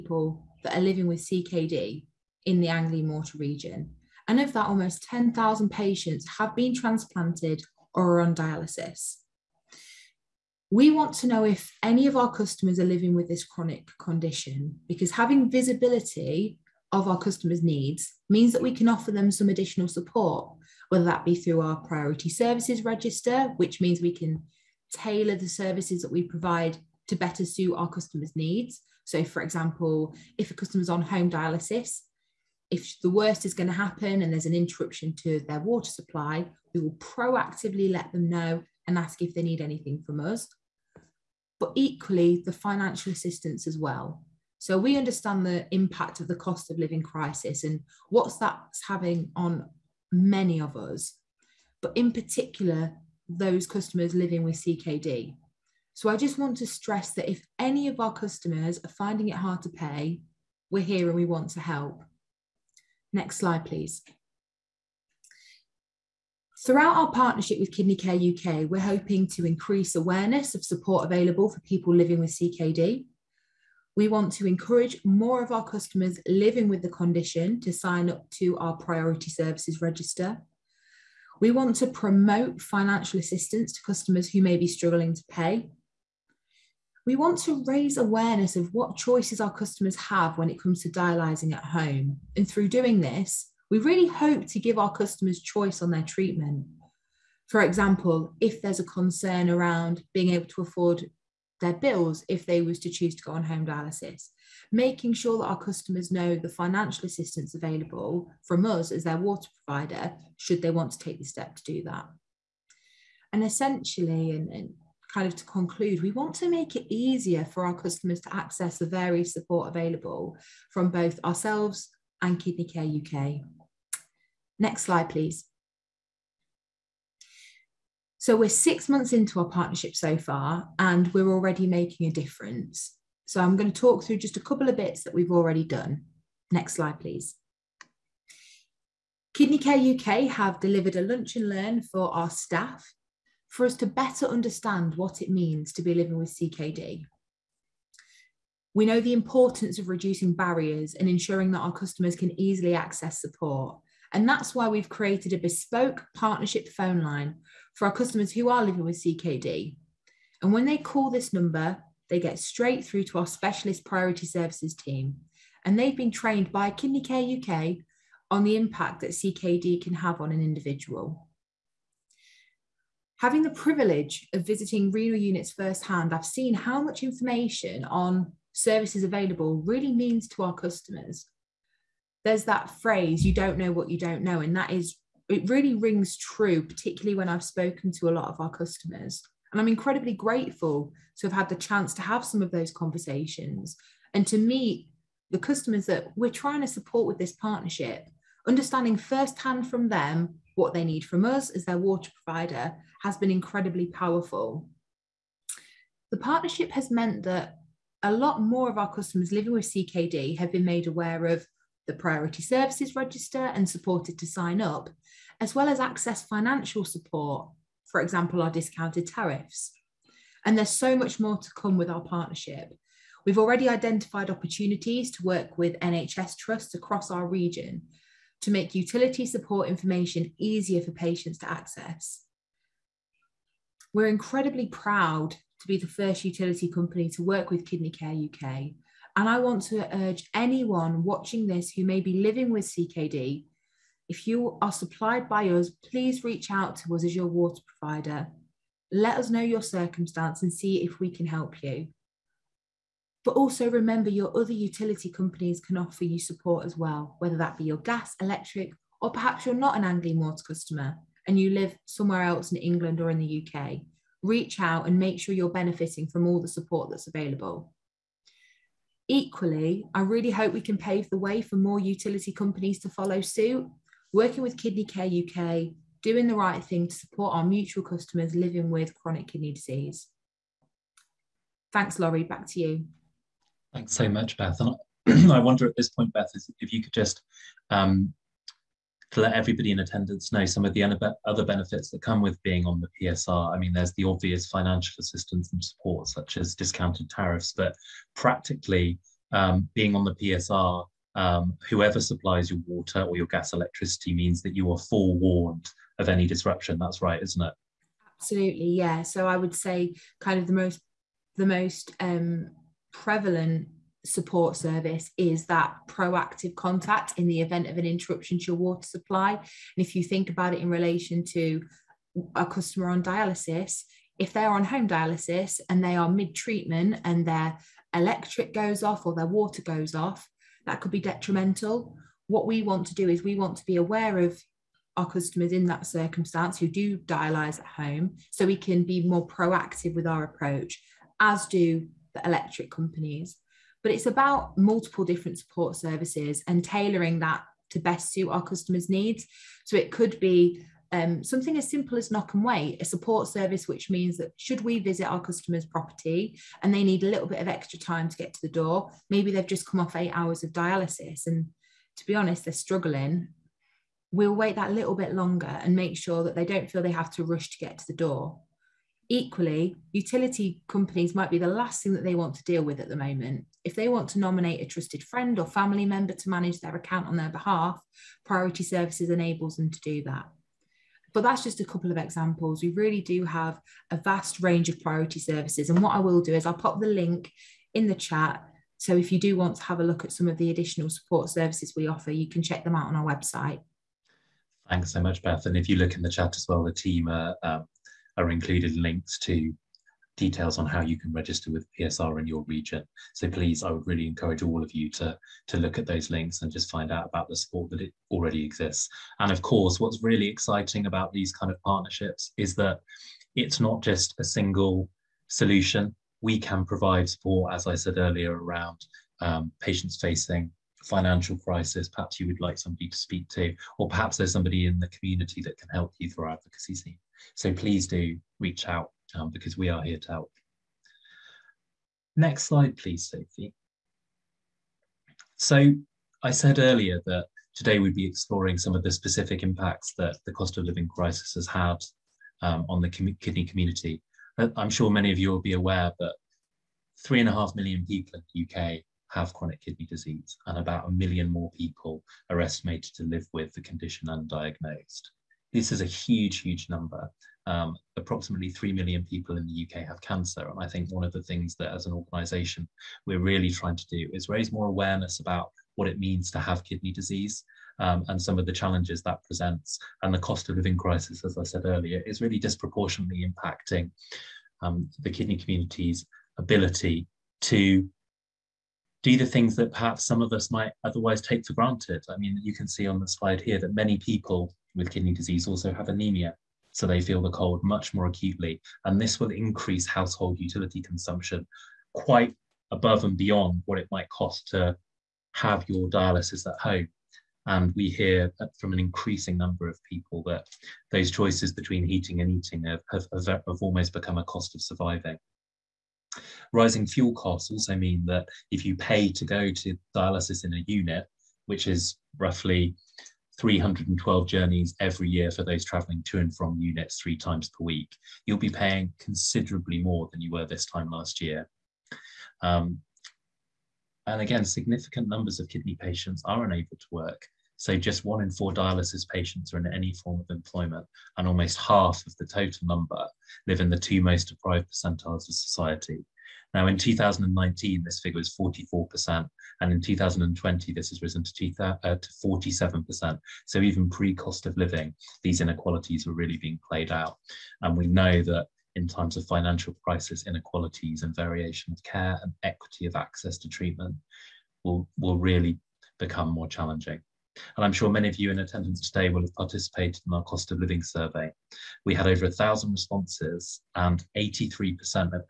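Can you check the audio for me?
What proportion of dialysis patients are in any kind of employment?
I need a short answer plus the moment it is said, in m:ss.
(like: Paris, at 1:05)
one in four, at 8:48.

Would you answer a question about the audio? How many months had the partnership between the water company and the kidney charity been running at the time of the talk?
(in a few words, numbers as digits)
6.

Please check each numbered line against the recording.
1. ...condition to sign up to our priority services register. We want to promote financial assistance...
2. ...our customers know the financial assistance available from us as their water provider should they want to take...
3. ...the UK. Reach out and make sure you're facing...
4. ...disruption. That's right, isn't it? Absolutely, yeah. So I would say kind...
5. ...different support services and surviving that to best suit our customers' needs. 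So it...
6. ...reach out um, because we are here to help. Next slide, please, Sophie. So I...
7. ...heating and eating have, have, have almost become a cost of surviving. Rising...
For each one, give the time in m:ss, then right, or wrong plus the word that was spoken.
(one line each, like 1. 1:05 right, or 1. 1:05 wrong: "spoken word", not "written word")
1. 1:16 right
2. 1:45 right
3. 4:23 wrong: "benefiting", not "facing"
4. 5:06 right
5. 5:45 wrong: "tailoring", not "surviving"
6. 7:08 right
7. 8:21 right.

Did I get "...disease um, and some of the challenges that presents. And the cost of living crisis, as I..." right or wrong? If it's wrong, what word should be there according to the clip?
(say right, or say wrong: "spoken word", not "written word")
right.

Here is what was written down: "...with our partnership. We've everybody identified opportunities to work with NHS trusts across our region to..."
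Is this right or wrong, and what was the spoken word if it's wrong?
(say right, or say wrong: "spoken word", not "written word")
wrong: "already", not "everybody".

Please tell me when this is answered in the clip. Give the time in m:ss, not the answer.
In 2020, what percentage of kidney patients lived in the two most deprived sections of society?
9:02.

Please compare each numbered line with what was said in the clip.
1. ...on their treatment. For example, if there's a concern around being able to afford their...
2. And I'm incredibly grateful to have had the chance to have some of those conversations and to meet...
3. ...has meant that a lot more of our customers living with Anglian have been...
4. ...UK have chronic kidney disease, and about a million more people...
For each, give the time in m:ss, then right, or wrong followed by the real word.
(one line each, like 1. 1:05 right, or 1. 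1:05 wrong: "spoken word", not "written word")
1. 1:35 right
2. 3:09 right
3. 3:26 wrong: "CKD", not "Anglian"
4. 7:28 right.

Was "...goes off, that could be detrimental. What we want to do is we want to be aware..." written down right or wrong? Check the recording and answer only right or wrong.
right.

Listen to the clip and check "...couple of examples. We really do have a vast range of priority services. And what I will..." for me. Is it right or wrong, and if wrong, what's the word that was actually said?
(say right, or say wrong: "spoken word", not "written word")
right.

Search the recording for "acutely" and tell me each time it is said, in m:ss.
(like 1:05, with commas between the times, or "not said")
8:08.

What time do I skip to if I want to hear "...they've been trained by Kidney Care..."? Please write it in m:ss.
2:45.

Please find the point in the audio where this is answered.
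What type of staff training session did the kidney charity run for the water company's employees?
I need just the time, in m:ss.
2:21.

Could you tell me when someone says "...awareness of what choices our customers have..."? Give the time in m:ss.
1:27.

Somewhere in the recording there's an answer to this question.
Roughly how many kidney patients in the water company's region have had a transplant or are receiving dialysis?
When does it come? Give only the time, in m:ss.
0:04.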